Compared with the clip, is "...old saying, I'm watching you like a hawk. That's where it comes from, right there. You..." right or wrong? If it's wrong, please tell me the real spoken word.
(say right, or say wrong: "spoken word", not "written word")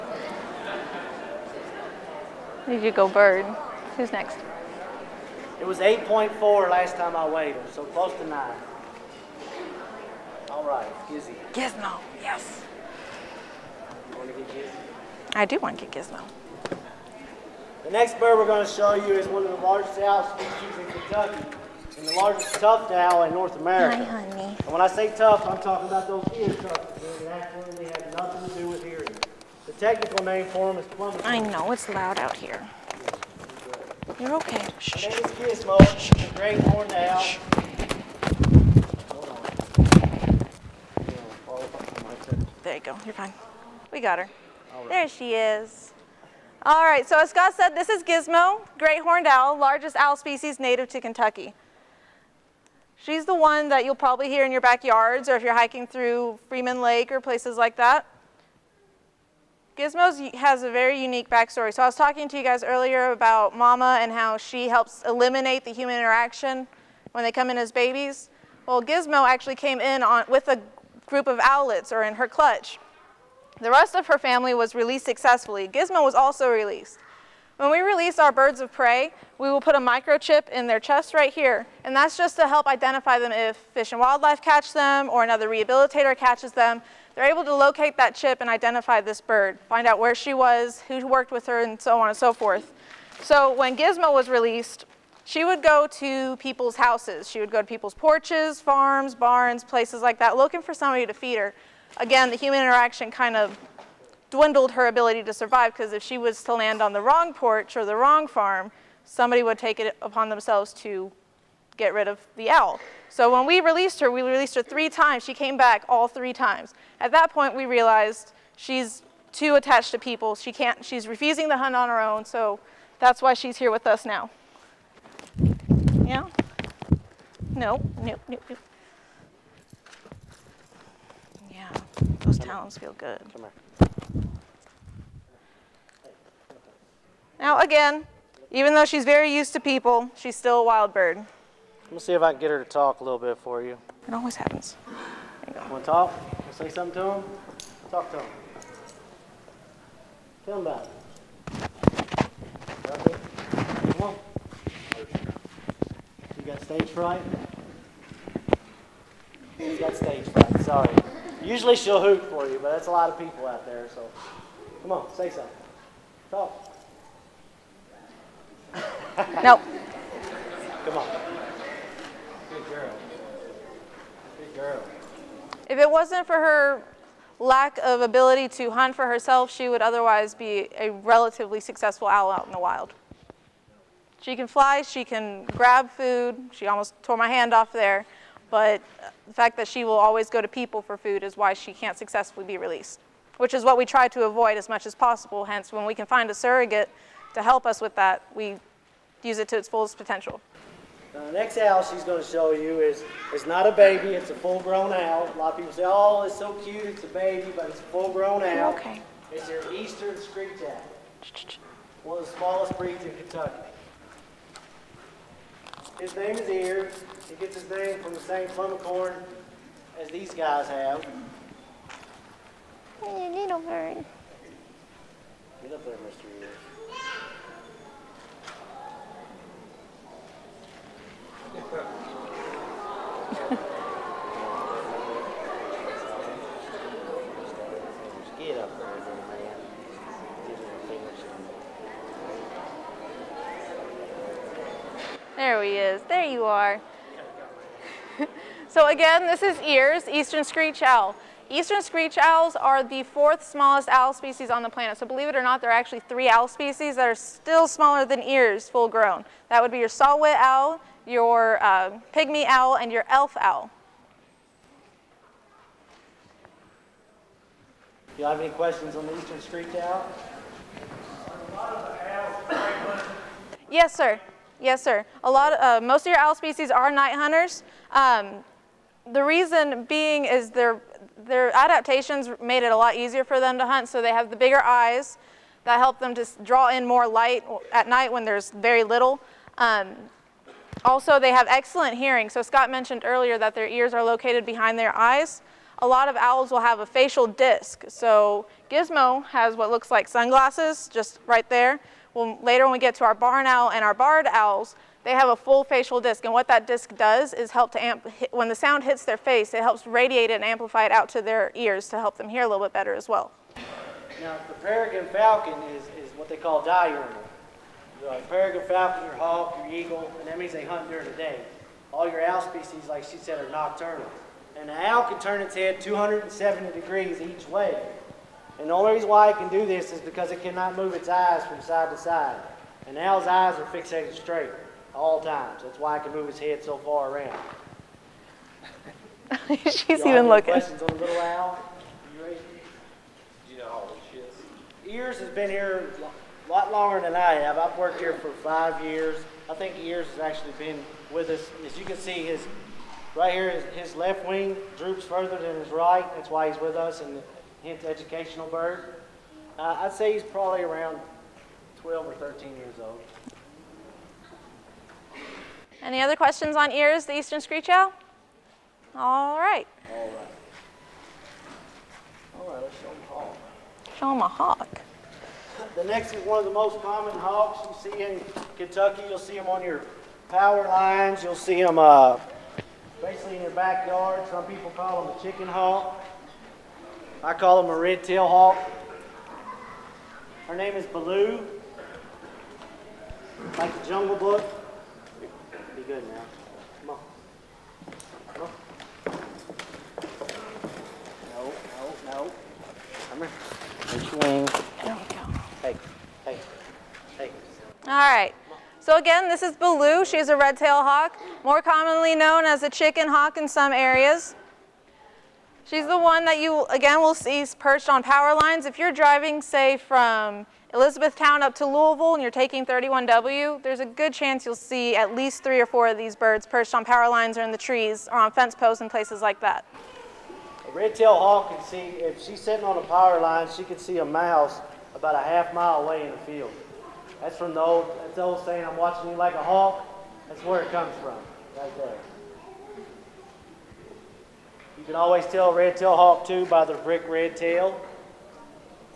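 right.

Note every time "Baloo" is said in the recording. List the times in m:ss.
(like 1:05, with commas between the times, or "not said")
6:30, 6:49.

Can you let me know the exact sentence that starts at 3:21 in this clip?
Now the next owl she's going to show you is, is not a baby, it's a full-grown owl.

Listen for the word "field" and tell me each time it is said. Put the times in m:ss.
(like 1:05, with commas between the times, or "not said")
7:16.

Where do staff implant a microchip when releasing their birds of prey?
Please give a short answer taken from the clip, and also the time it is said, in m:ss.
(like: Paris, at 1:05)
in their chest, at 1:20.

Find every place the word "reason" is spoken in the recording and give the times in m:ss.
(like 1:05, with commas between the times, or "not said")
4:39, 5:28.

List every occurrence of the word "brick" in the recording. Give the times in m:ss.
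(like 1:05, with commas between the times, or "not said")
7:26.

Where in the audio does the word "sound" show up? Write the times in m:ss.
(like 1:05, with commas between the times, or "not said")
5:08.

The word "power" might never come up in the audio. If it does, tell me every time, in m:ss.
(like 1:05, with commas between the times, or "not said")
6:20, 6:58, 7:06, 7:12.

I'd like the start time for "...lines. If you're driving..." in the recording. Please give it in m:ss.
6:58.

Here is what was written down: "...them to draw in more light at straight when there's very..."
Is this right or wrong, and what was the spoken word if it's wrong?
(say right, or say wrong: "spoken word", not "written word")
wrong: "night", not "straight".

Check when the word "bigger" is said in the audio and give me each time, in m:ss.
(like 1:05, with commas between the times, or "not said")
4:44.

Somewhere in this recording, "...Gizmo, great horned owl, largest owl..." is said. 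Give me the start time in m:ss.
0:48.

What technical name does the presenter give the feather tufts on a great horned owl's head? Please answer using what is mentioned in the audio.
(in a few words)
plummet.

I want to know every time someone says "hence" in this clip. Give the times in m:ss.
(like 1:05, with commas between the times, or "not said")
3:15, 5:57.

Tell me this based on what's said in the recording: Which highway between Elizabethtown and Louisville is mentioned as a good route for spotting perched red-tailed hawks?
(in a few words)
31W.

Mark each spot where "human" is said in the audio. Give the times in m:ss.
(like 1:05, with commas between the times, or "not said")
1:05, 1:42.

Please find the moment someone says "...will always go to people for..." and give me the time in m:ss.
3:09.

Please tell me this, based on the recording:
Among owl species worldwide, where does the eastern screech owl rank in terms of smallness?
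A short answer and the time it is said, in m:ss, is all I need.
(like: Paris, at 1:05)
fourth smallest, at 4:13.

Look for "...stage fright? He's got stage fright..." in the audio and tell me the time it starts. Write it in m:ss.
2:36.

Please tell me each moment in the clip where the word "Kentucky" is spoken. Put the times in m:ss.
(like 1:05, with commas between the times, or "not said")
0:20, 0:51, 3:33, 6:18.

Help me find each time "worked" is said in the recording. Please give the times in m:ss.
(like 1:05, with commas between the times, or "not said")
1:31, 5:47.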